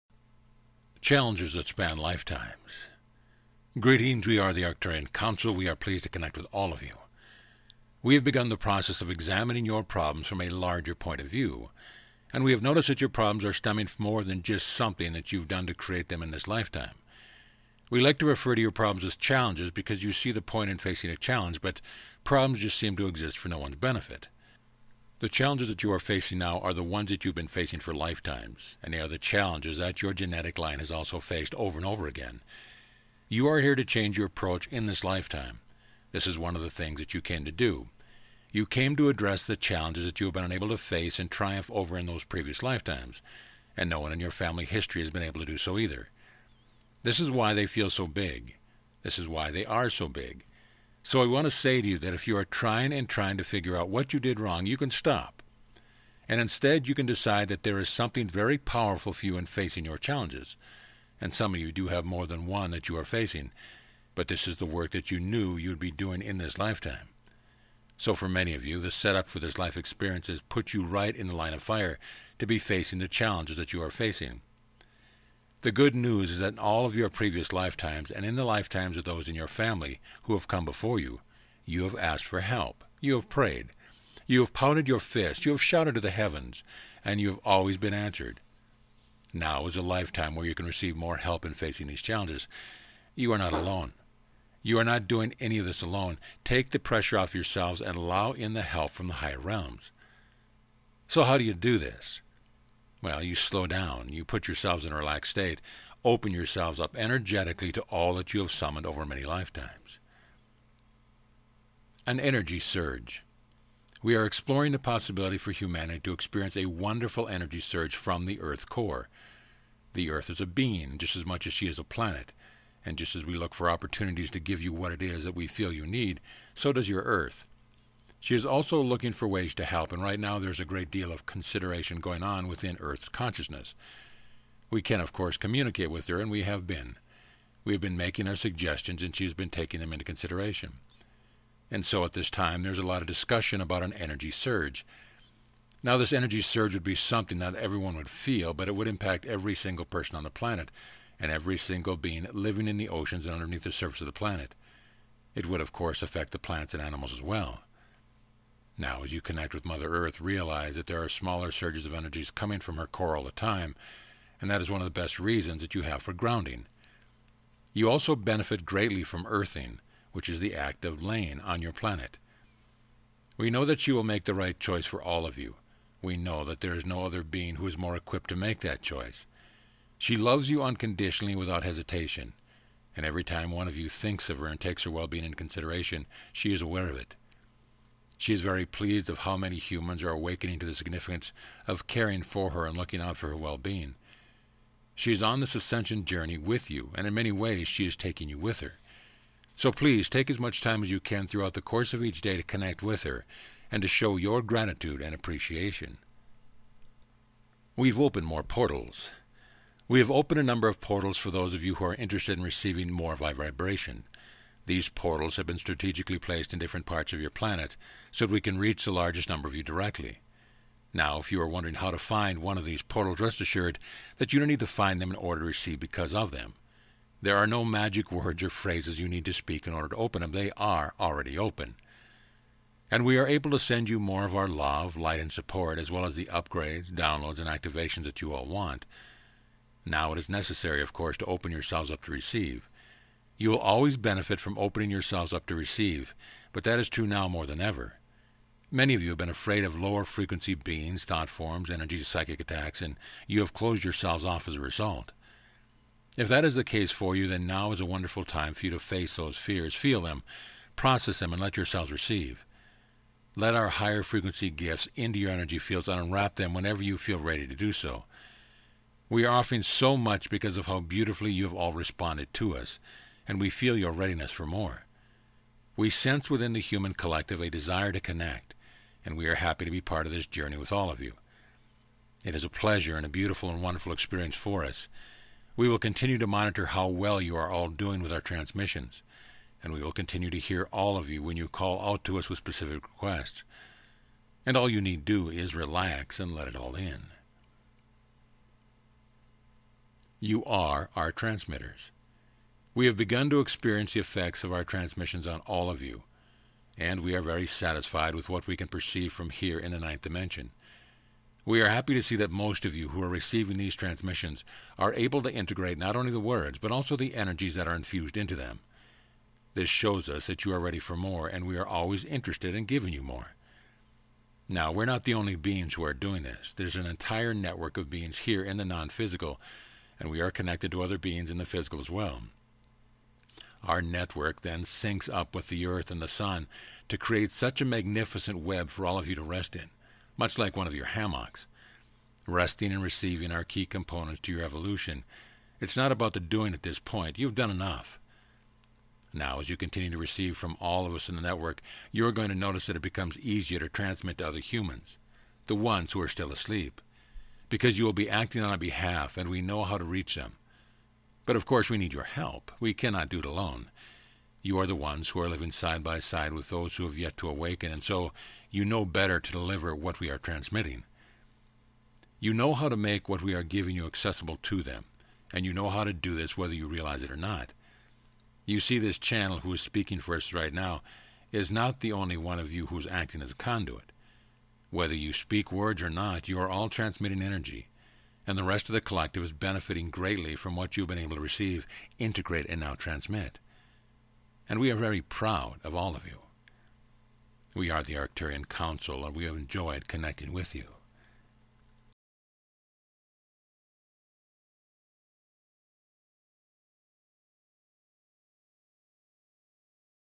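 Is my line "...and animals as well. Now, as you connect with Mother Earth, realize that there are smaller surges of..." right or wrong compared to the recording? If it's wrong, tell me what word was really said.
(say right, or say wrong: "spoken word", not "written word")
right.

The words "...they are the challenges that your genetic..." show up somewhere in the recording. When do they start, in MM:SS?
00:28.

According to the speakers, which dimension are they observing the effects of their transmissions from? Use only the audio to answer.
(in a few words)
Ninth dimension.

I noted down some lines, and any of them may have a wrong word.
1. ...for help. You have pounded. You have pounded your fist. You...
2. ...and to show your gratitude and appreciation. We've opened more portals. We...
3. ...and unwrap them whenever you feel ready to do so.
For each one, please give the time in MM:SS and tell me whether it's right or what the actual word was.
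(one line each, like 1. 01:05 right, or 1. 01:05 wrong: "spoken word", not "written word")
1. 01:22 wrong: "prayed", not "pounded"
2. 03:23 right
3. 04:25 right.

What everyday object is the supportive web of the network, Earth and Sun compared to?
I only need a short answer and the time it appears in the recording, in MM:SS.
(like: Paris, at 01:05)
Hammocks, at 05:40.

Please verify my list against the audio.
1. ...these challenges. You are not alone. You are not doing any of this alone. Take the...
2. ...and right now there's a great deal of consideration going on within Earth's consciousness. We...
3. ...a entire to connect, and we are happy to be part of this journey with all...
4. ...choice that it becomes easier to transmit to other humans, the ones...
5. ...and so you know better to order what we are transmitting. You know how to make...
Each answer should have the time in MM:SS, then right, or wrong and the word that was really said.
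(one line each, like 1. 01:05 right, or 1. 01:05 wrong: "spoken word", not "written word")
1. 01:31 right
2. 02:09 right
3. 04:37 wrong: "desire", not "entire"
4. 05:52 wrong: "notice", not "choice"
5. 06:07 wrong: "deliver", not "order".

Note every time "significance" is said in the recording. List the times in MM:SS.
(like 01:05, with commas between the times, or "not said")
03:10.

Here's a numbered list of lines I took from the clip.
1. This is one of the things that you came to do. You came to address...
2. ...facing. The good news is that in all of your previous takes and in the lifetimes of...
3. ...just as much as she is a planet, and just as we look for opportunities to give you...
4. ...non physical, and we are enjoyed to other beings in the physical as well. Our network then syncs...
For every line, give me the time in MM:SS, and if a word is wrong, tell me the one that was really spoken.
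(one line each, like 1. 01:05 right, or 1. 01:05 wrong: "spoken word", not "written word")
1. 00:36 right
2. 01:13 wrong: "lifetimes", not "takes"
3. 02:00 right
4. 05:28 wrong: "connected", not "enjoyed".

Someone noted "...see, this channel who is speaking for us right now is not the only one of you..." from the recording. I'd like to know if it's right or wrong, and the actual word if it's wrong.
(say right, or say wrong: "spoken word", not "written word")
right.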